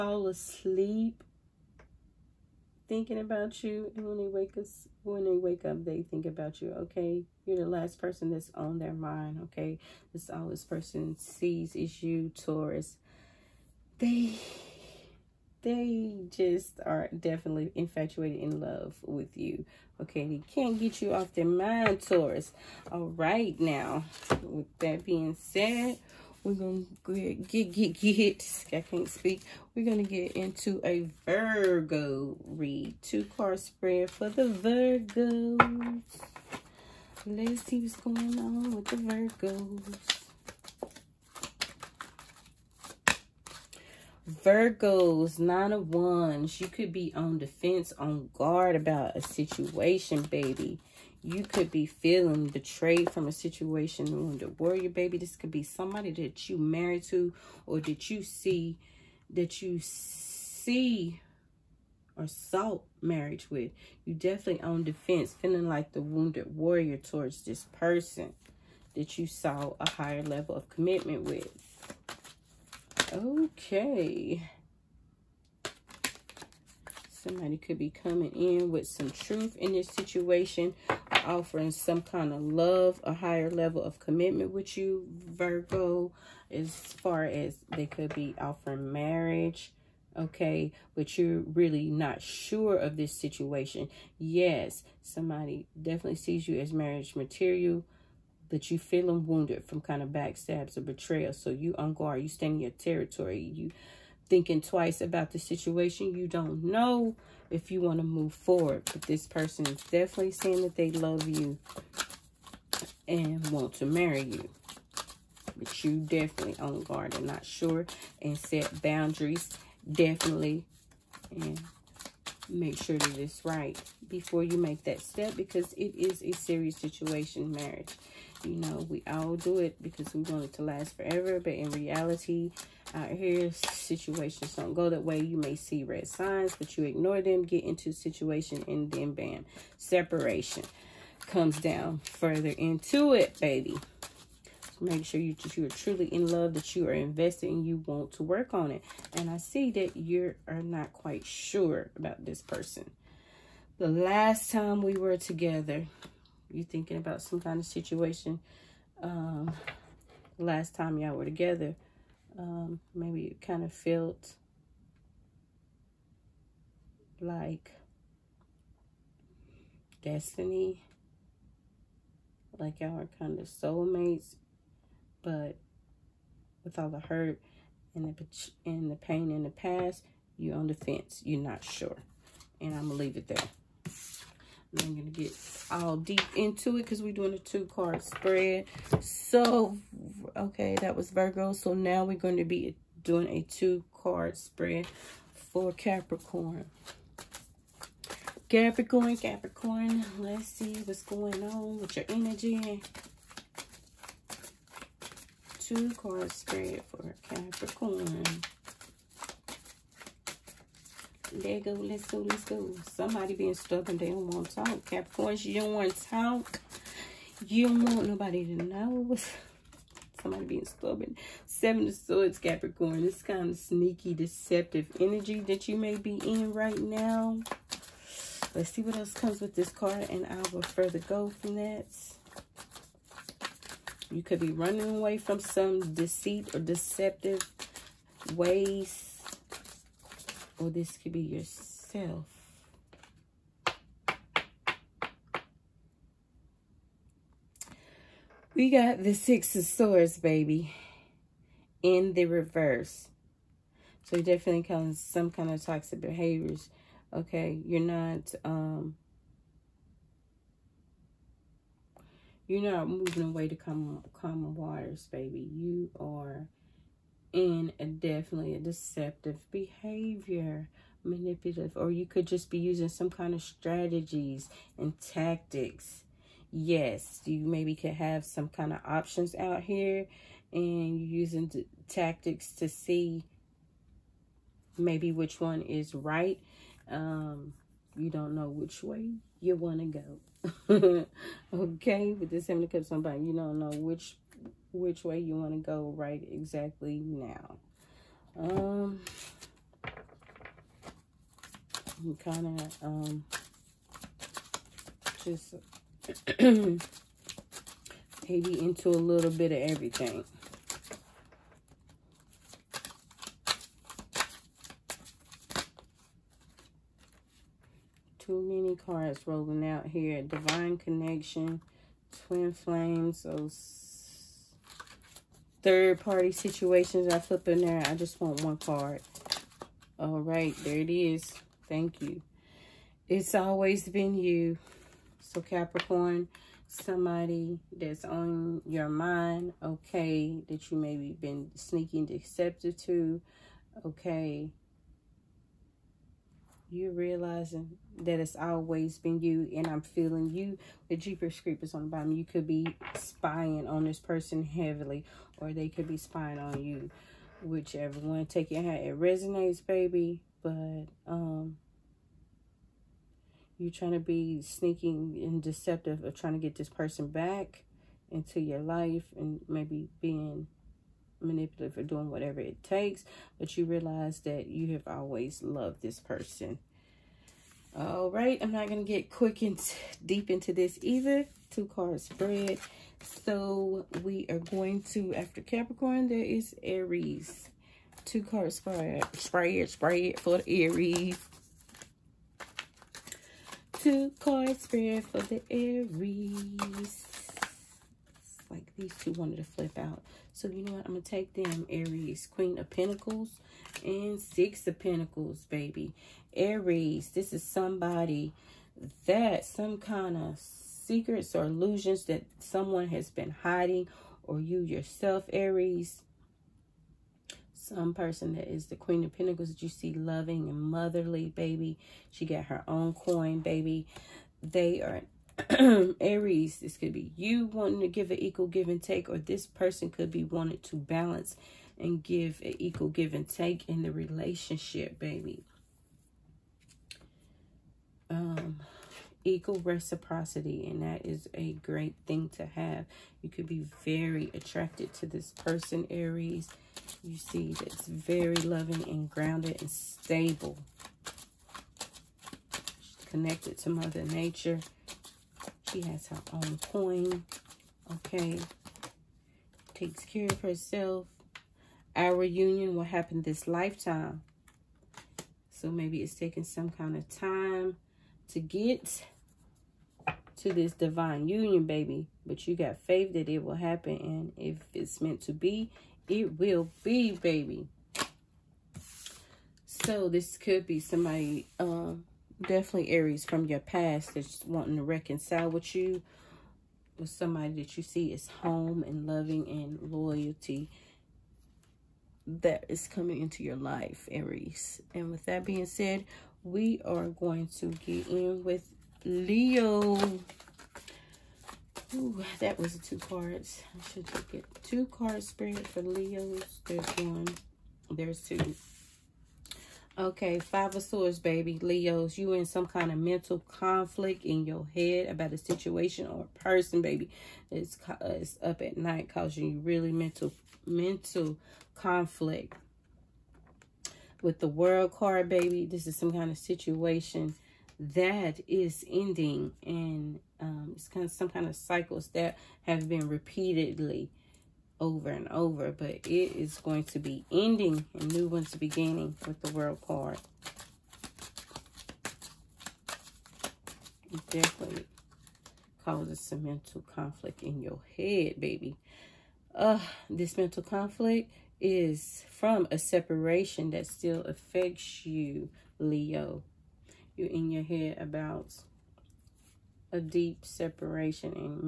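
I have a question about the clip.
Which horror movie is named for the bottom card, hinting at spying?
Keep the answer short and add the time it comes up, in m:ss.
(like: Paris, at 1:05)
Jeepers Creepers, at 5:50.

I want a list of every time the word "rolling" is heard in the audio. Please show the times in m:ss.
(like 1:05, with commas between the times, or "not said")
5:19.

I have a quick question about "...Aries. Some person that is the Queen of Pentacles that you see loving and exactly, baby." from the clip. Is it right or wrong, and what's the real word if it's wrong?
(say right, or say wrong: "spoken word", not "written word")
wrong: "motherly", not "exactly".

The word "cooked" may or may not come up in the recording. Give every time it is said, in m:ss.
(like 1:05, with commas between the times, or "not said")
not said.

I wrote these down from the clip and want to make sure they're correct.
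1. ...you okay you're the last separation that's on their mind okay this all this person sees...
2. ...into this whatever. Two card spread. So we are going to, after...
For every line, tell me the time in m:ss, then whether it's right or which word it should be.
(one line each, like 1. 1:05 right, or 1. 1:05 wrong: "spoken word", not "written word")
1. 0:06 wrong: "person", not "separation"
2. 6:20 wrong: "either", not "whatever".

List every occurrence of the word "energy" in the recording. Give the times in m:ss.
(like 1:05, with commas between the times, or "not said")
3:22, 3:44.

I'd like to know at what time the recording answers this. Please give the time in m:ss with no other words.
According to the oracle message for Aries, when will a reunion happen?
7:43.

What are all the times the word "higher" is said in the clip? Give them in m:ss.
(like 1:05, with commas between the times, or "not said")
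1:09, 1:23.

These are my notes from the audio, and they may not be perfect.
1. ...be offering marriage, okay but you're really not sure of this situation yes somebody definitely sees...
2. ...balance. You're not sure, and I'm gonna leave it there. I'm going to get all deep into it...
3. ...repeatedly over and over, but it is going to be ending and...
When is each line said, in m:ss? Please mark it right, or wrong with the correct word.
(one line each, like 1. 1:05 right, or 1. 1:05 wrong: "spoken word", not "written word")
1. 1:28 right
2. 3:00 wrong: "fence", not "balance"
3. 8:53 right.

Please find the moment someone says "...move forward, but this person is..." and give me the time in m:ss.
1:48.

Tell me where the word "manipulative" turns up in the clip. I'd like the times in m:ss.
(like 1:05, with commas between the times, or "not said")
4:31, 6:11.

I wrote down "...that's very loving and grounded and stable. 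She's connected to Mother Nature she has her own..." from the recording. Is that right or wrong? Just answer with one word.
right.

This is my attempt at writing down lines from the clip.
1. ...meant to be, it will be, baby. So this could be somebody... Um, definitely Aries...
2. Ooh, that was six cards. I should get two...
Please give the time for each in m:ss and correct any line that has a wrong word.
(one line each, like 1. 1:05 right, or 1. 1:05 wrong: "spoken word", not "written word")
1. 7:54 right
2. 8:21 wrong: "two", not "six".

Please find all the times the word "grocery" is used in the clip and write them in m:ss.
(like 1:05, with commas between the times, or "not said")
not said.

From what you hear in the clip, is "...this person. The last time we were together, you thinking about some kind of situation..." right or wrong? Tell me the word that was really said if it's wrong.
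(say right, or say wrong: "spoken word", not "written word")
right.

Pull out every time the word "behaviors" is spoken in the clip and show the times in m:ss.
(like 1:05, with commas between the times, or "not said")
4:15, 4:29.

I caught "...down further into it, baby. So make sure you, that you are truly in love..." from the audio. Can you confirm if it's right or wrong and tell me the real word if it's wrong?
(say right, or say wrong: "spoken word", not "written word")
right.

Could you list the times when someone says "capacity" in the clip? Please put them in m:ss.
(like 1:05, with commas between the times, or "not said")
not said.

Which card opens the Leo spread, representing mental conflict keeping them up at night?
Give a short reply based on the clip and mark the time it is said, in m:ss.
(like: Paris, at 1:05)
Five of Swords, at 8:30.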